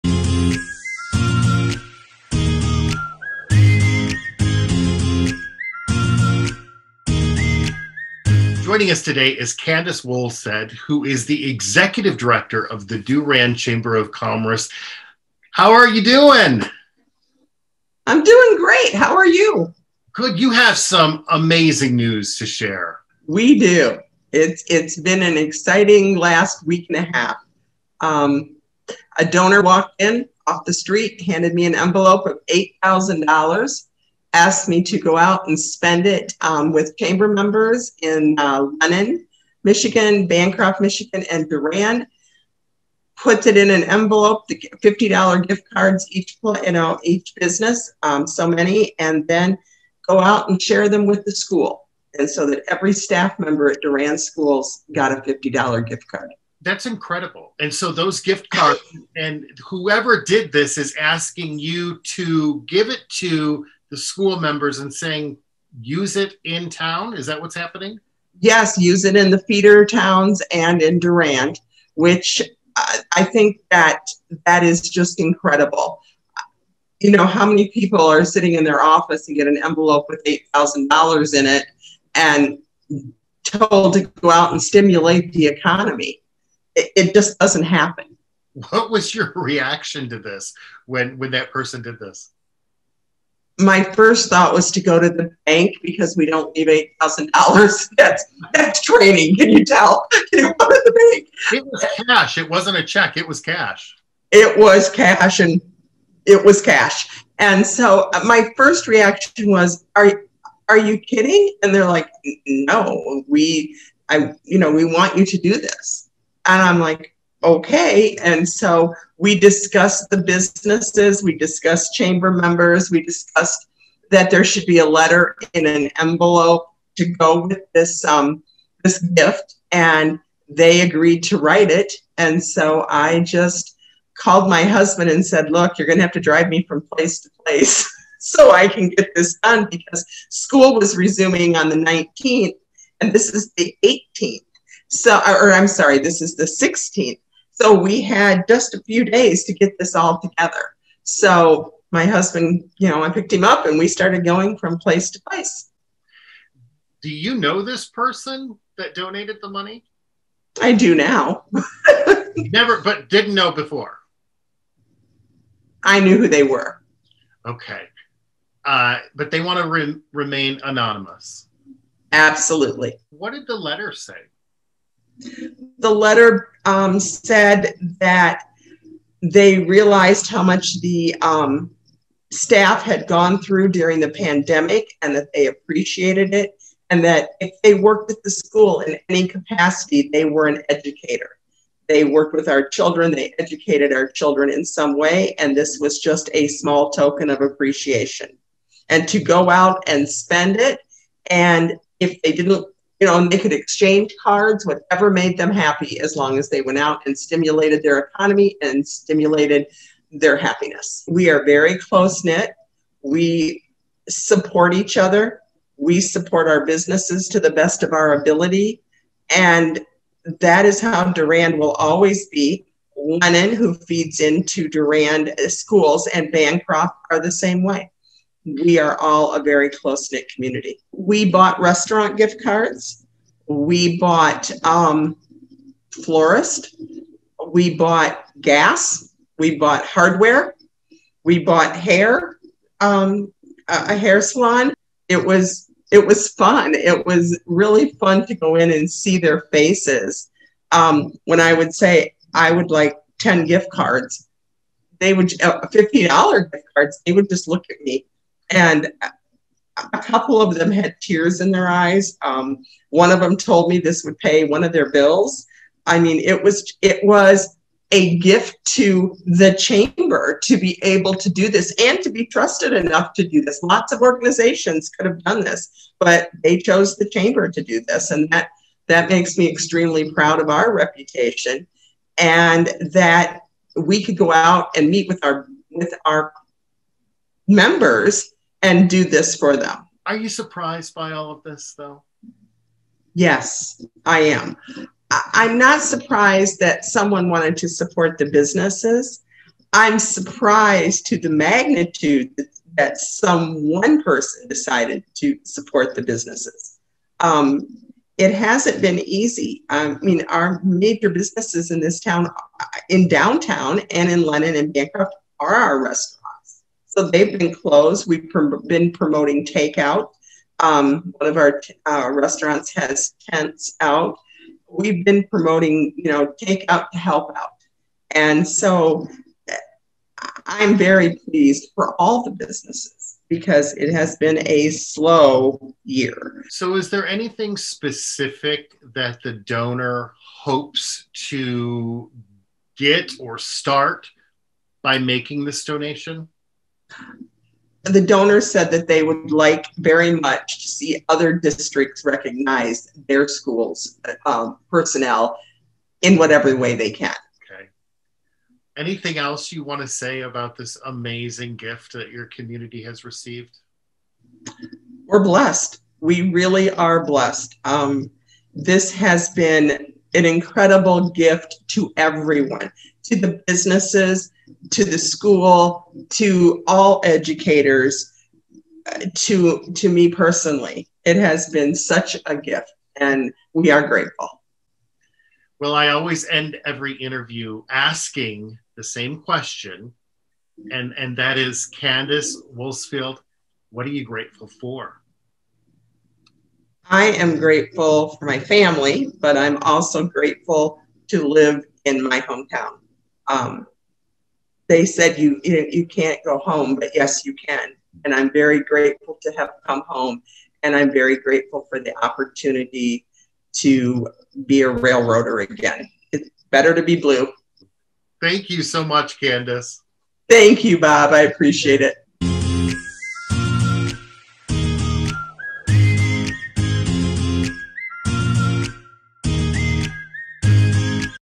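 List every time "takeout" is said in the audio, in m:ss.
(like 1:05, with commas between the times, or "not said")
5:19, 5:26.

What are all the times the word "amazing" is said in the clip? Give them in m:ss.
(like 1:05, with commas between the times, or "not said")
0:21, 6:00.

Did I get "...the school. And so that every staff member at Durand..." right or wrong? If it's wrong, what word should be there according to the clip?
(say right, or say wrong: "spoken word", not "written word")
right.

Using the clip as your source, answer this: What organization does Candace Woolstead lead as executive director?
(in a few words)
Durand Chamber of Commerce.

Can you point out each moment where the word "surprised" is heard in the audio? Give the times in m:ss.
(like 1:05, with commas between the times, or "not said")
4:50, 4:55, 4:59.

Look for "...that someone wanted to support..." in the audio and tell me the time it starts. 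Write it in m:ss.
4:56.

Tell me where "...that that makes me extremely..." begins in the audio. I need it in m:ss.
4:38.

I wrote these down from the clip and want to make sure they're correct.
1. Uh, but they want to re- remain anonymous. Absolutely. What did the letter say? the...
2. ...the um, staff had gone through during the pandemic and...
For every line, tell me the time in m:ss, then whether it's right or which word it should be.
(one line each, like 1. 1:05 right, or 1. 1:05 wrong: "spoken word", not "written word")
1. 2:48 right
2. 3:00 right.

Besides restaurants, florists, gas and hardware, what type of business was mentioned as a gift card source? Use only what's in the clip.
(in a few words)
Hair salon.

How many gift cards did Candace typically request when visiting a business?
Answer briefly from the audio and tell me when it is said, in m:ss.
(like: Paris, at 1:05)
10, at 4:13.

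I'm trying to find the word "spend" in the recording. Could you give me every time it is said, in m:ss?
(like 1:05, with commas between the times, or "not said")
0:35, 3:20.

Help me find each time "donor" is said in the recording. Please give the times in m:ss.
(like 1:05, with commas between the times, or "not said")
0:29, 5:39, 5:48.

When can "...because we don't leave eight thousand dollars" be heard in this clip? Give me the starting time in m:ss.
1:35.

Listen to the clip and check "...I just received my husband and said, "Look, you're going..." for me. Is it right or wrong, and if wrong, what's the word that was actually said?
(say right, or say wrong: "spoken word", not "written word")
wrong: "called", not "received".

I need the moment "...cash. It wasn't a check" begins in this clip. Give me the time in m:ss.
1:42.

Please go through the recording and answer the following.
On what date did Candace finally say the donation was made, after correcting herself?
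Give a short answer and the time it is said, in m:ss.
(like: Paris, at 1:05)
The 16th, at 2:26.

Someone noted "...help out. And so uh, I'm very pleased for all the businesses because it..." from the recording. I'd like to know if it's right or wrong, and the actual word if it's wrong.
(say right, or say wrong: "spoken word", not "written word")
right.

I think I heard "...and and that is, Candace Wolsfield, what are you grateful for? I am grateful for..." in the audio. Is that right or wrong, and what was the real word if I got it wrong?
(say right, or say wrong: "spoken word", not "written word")
right.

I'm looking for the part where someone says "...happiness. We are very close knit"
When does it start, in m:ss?
3:30.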